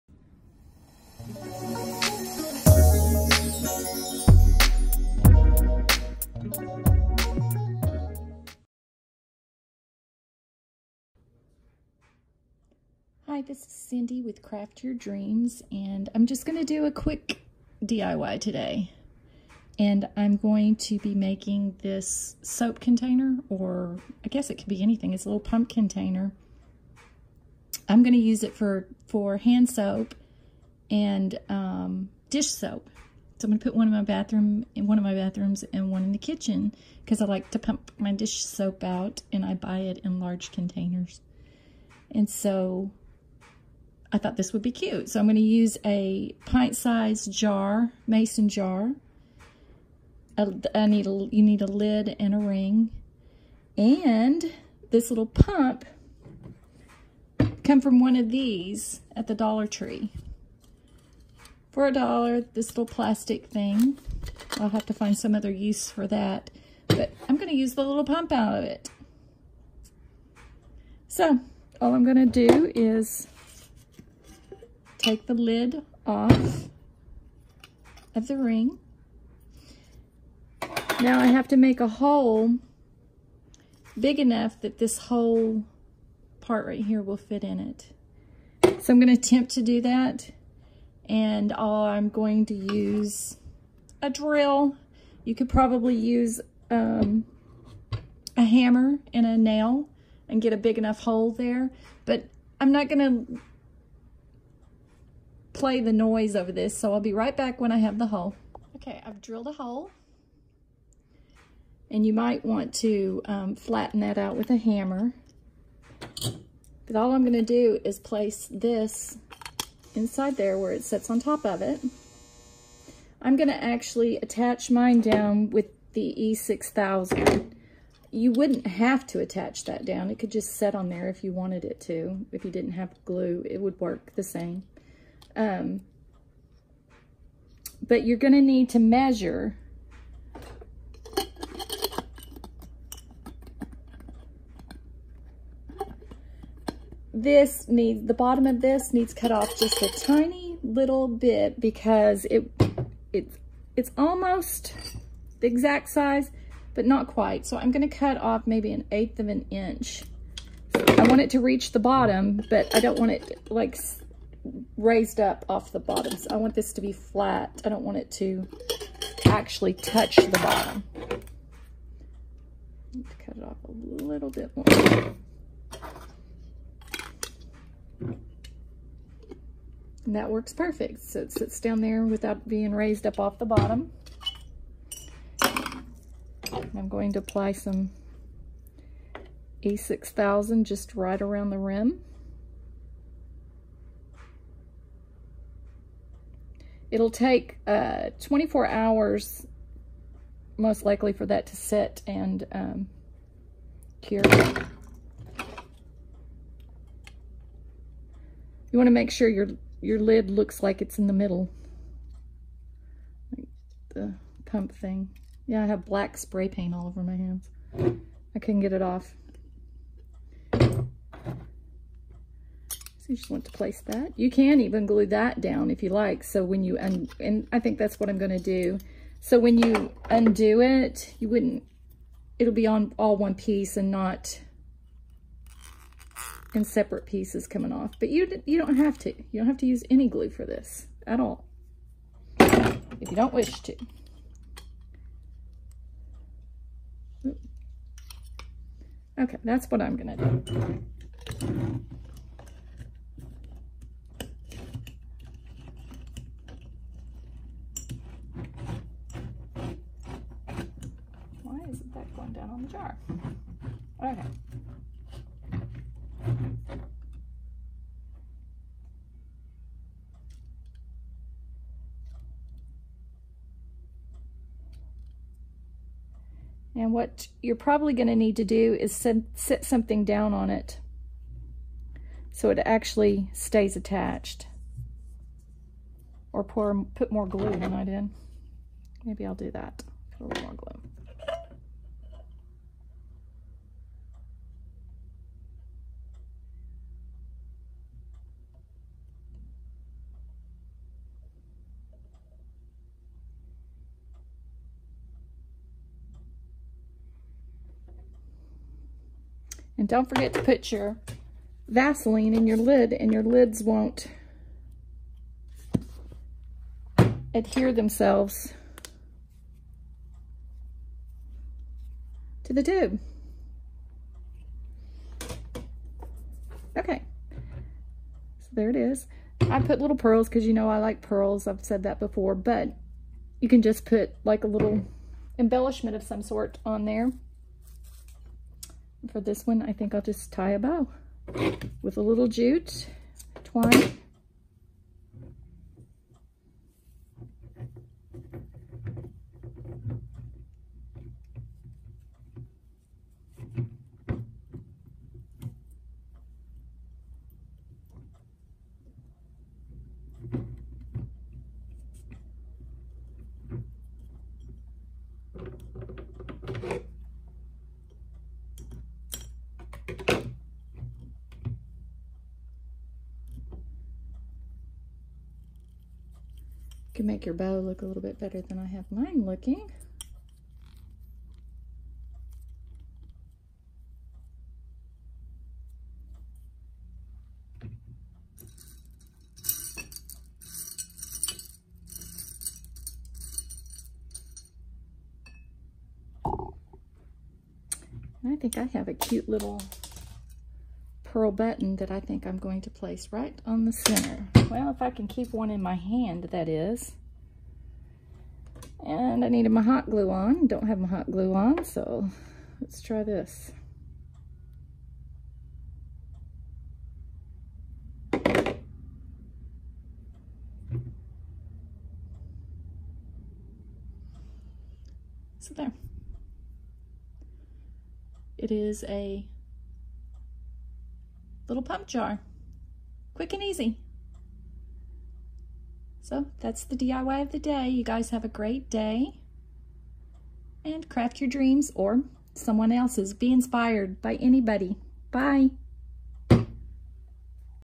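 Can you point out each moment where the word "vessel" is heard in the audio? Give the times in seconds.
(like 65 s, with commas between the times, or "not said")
not said.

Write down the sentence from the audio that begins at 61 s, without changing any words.
For a dollar, this little plastic thing.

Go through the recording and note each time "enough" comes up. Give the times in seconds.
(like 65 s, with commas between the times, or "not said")
84 s, 100 s.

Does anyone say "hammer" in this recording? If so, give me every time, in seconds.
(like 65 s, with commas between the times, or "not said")
98 s, 114 s.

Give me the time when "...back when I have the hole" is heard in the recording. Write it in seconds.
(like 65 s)
107 s.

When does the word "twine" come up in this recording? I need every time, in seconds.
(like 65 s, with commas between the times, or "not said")
343 s.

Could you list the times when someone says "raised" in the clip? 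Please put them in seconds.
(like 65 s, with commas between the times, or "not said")
164 s, 182 s.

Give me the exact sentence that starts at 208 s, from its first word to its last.
You want to make sure your your lid looks like it's in the middle.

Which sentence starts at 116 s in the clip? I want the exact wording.
But all I'm gonna do is place this inside there where it sits on top of it.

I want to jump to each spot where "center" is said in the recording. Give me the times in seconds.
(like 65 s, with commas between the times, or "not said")
403 s.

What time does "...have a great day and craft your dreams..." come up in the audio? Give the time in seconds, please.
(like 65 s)
438 s.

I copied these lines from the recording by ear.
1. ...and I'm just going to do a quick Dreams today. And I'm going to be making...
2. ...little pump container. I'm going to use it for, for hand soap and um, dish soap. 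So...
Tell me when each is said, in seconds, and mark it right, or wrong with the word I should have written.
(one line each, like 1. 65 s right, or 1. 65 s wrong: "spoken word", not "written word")
1. 15 s wrong: "DIY", not "Dreams"
2. 25 s right.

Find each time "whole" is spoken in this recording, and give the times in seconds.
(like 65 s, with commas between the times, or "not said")
84 s.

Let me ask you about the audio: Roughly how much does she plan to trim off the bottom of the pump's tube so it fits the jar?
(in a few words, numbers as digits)
an eighth of an inch.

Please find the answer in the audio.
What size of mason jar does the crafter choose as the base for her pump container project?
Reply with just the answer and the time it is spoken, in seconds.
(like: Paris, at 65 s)
pint-sized, at 46 s.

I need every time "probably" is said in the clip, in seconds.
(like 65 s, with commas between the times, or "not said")
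95 s, 277 s.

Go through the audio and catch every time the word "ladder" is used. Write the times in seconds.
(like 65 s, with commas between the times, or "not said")
not said.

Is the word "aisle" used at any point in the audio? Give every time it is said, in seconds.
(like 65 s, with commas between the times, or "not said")
not said.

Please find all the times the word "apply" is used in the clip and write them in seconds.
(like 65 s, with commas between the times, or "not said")
187 s.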